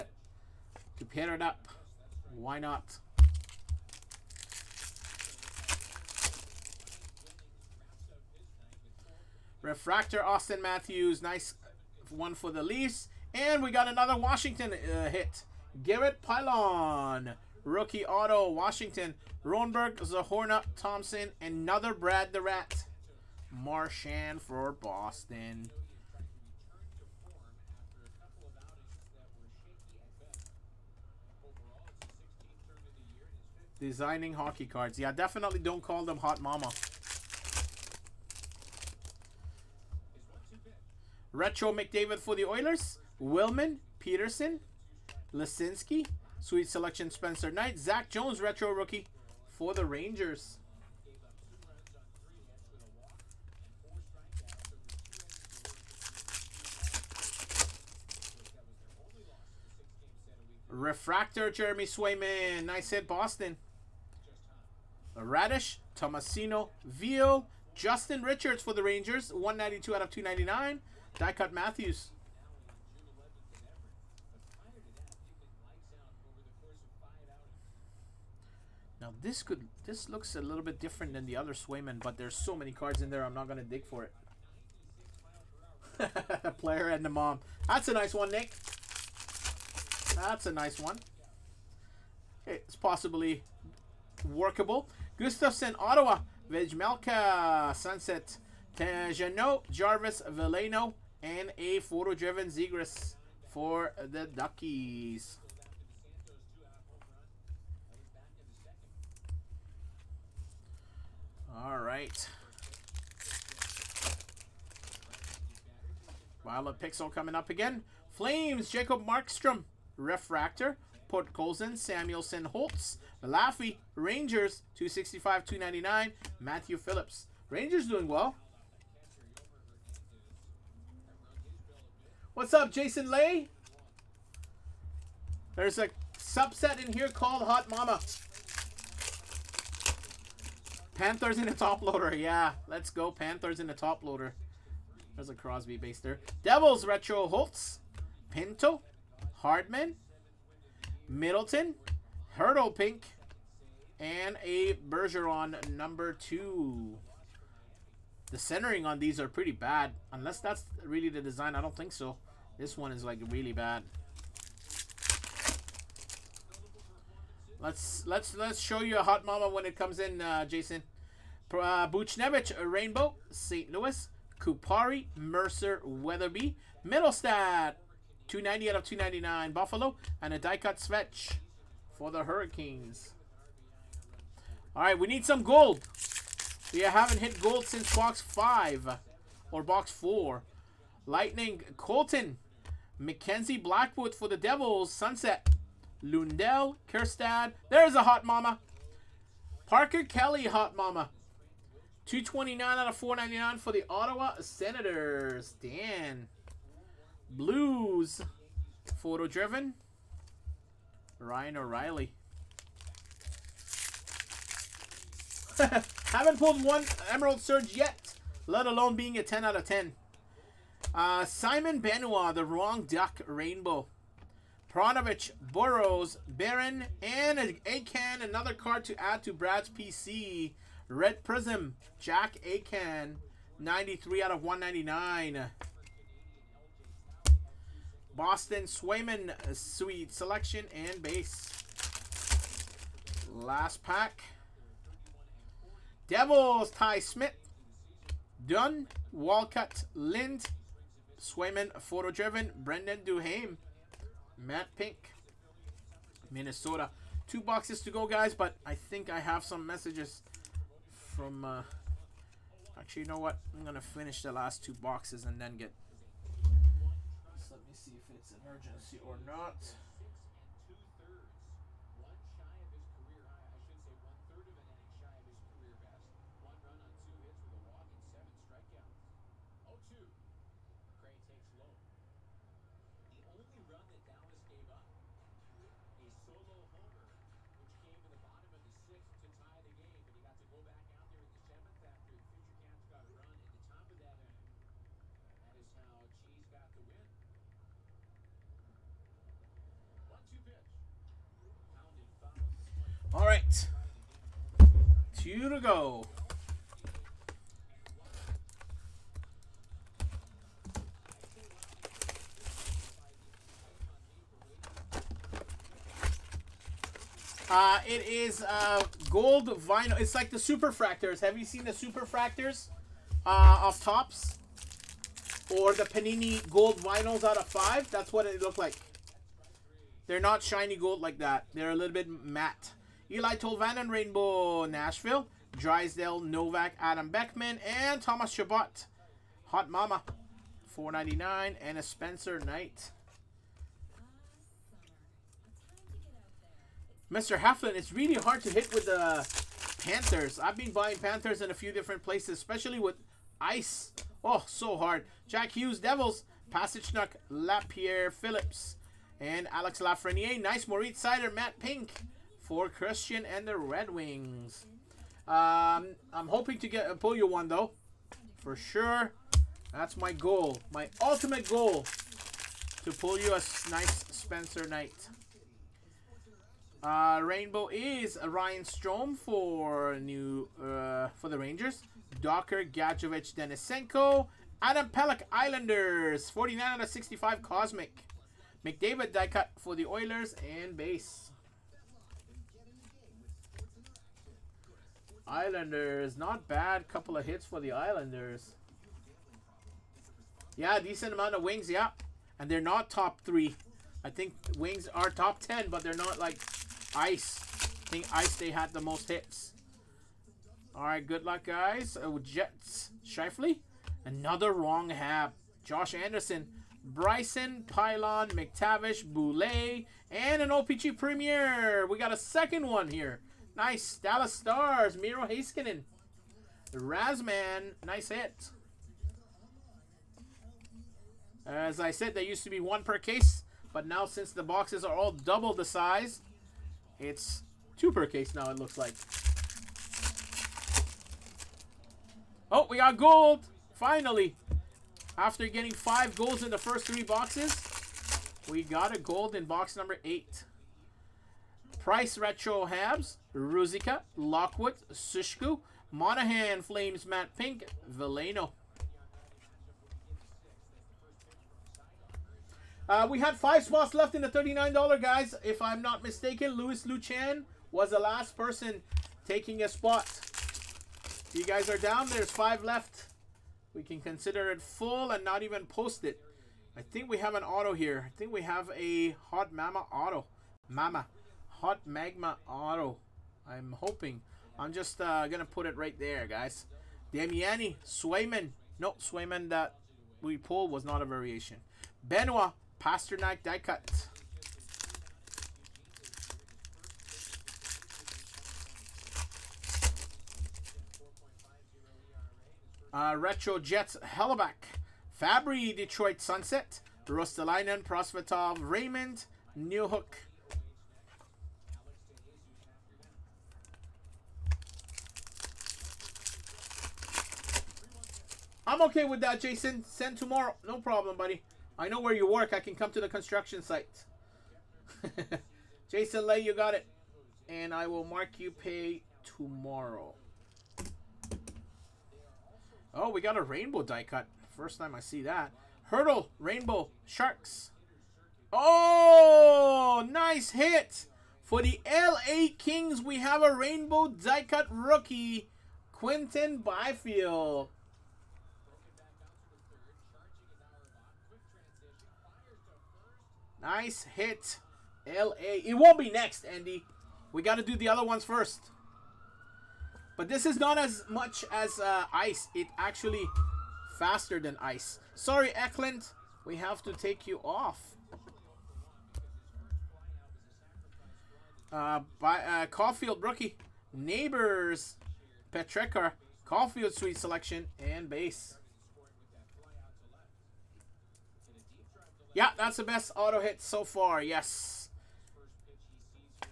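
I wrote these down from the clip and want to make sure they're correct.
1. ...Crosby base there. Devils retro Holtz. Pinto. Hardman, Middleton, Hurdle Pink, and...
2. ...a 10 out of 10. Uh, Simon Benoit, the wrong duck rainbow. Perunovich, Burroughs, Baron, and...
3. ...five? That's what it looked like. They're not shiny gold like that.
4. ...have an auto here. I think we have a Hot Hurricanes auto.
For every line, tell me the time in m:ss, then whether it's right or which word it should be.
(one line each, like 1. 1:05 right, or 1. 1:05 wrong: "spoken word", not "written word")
1. 2:25 right
2. 3:39 right
3. 5:27 right
4. 7:57 wrong: "Mama", not "Hurricanes".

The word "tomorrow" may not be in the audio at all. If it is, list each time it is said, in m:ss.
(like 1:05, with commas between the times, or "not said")
8:40, 8:49.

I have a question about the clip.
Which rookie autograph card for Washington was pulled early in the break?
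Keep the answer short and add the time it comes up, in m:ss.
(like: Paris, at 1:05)
Garrett Pilon, at 0:15.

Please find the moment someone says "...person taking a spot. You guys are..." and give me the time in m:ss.
7:48.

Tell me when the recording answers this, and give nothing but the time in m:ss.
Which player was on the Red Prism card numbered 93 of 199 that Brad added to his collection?
3:51.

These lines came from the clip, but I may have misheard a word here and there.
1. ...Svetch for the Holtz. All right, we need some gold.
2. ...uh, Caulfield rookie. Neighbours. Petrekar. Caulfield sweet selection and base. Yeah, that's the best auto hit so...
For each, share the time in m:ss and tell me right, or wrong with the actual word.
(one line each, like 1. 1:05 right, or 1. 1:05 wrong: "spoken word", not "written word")
1. 3:00 wrong: "Hurricanes", not "Holtz"
2. 9:32 right.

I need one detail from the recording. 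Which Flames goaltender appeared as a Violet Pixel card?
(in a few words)
Jacob Markstrom.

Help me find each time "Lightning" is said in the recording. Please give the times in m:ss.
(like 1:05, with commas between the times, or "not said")
3:11.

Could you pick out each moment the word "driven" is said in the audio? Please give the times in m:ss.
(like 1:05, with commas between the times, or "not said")
1:41, 3:29, 4:12.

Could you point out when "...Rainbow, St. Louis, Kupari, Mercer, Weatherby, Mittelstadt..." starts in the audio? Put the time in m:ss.
2:52.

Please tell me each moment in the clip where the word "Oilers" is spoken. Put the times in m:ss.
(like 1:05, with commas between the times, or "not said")
0:42, 6:29.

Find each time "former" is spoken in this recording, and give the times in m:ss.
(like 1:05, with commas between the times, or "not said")
not said.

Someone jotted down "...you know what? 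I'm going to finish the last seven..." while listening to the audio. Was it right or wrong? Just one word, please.
wrong.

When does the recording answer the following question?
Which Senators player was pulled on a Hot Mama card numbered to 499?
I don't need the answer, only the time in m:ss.
3:19.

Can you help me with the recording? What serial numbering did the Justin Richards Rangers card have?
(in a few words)
192 out of 299.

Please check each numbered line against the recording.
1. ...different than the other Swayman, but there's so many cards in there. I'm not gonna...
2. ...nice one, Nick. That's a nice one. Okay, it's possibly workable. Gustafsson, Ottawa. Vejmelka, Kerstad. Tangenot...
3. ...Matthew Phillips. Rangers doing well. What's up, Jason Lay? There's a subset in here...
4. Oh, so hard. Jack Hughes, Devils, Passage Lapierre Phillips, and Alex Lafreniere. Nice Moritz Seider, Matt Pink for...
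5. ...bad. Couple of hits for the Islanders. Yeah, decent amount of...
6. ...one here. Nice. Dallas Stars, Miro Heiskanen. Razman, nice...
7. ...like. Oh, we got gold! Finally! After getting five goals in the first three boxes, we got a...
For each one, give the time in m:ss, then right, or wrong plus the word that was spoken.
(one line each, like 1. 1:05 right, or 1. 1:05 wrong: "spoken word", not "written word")
1. 1:20 right
2. 1:27 wrong: "Sunset", not "Kerstad"
3. 2:06 right
4. 5:54 right
5. 6:36 right
6. 7:02 right
7. 7:18 right.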